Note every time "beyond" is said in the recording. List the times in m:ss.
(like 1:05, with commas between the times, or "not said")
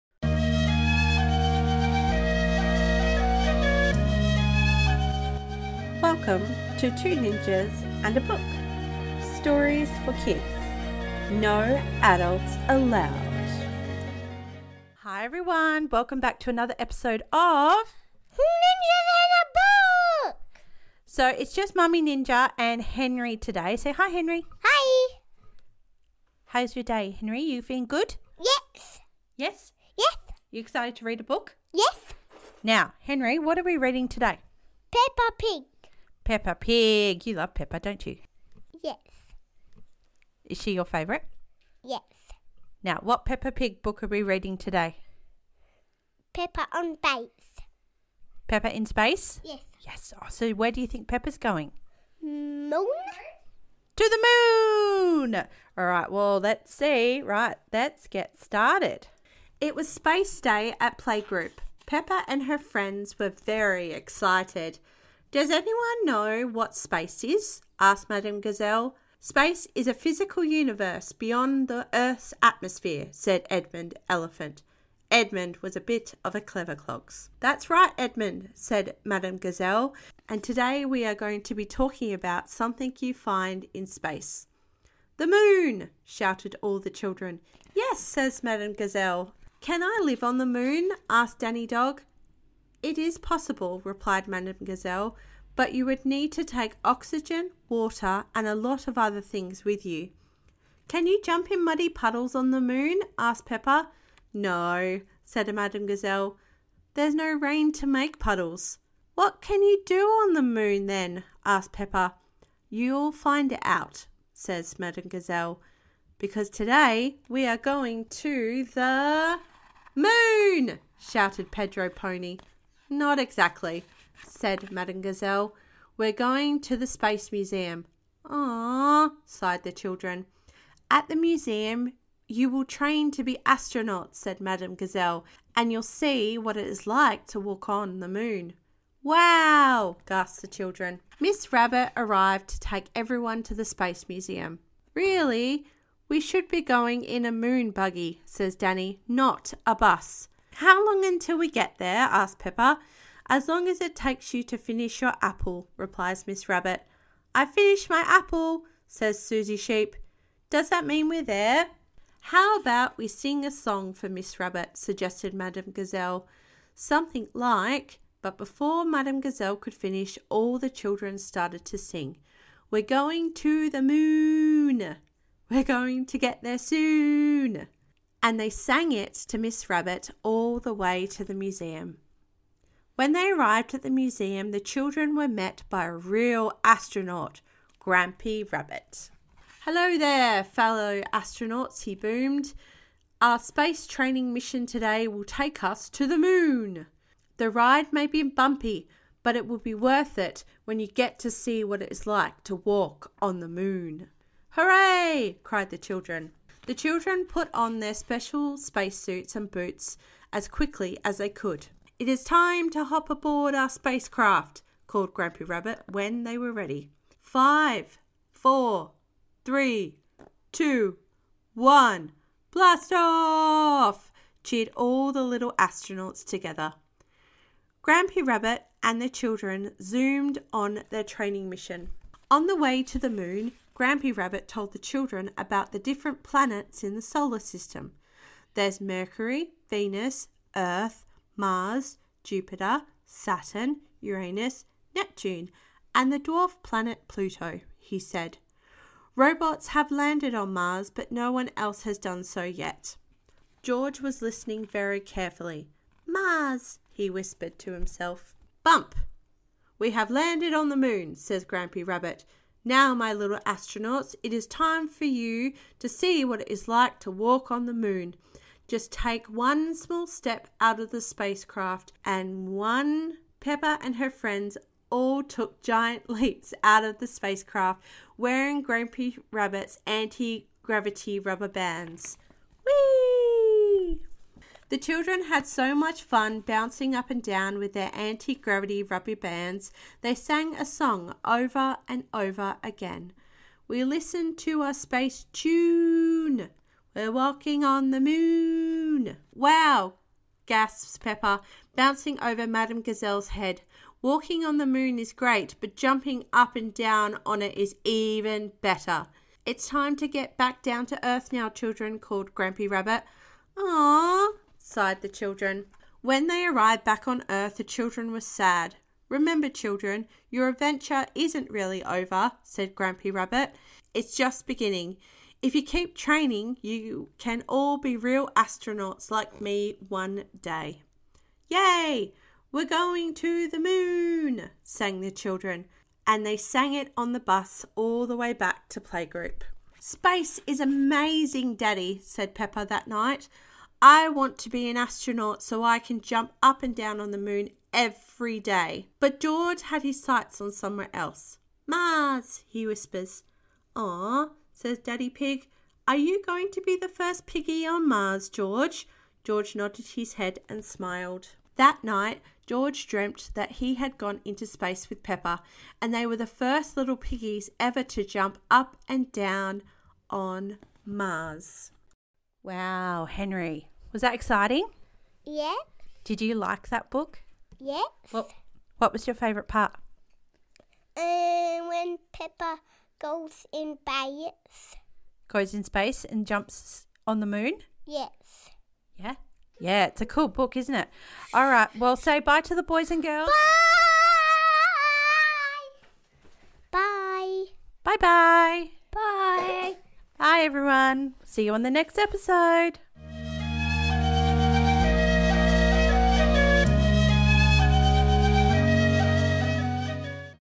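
1:11.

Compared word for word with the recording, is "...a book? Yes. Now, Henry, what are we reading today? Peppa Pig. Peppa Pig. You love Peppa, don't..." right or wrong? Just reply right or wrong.
right.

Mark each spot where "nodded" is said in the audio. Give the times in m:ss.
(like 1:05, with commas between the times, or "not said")
5:59.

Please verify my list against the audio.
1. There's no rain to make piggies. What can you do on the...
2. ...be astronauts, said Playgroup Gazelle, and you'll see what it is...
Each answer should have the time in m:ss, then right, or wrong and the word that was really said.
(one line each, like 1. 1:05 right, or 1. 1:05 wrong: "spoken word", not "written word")
1. 1:46 wrong: "puddles", not "piggies"
2. 2:13 wrong: "Madame", not "Playgroup".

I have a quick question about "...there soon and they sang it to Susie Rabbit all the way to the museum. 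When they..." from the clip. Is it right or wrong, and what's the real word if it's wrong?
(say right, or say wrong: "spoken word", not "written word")
wrong: "Miss", not "Susie".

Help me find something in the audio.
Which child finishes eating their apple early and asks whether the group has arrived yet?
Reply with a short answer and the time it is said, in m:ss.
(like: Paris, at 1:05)
Susie Sheep, at 2:39.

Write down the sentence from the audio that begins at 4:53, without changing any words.
We listened to a space tune.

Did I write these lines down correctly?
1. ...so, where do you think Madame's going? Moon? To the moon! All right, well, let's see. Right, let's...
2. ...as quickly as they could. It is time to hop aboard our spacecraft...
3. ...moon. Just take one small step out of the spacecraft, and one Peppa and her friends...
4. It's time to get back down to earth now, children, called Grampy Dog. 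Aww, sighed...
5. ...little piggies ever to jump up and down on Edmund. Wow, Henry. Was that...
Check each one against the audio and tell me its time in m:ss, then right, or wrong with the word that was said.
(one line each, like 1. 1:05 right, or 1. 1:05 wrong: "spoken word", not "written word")
1. 0:50 wrong: "Peppa", not "Madame"
2. 3:30 right
3. 4:27 right
4. 5:09 wrong: "Rabbit", not "Dog"
5. 6:06 wrong: "Mars", not "Edmund".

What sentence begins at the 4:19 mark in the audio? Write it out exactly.
We have landed on the moon, says Grampy Rabbit.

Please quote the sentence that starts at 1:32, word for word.
It is possible, replied Madame Gazelle, but you would need to take oxygen, water, and a lot of other things with you.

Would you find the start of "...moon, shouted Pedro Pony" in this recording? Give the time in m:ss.
1:59.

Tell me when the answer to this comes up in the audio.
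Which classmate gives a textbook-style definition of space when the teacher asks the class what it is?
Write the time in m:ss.
1:13.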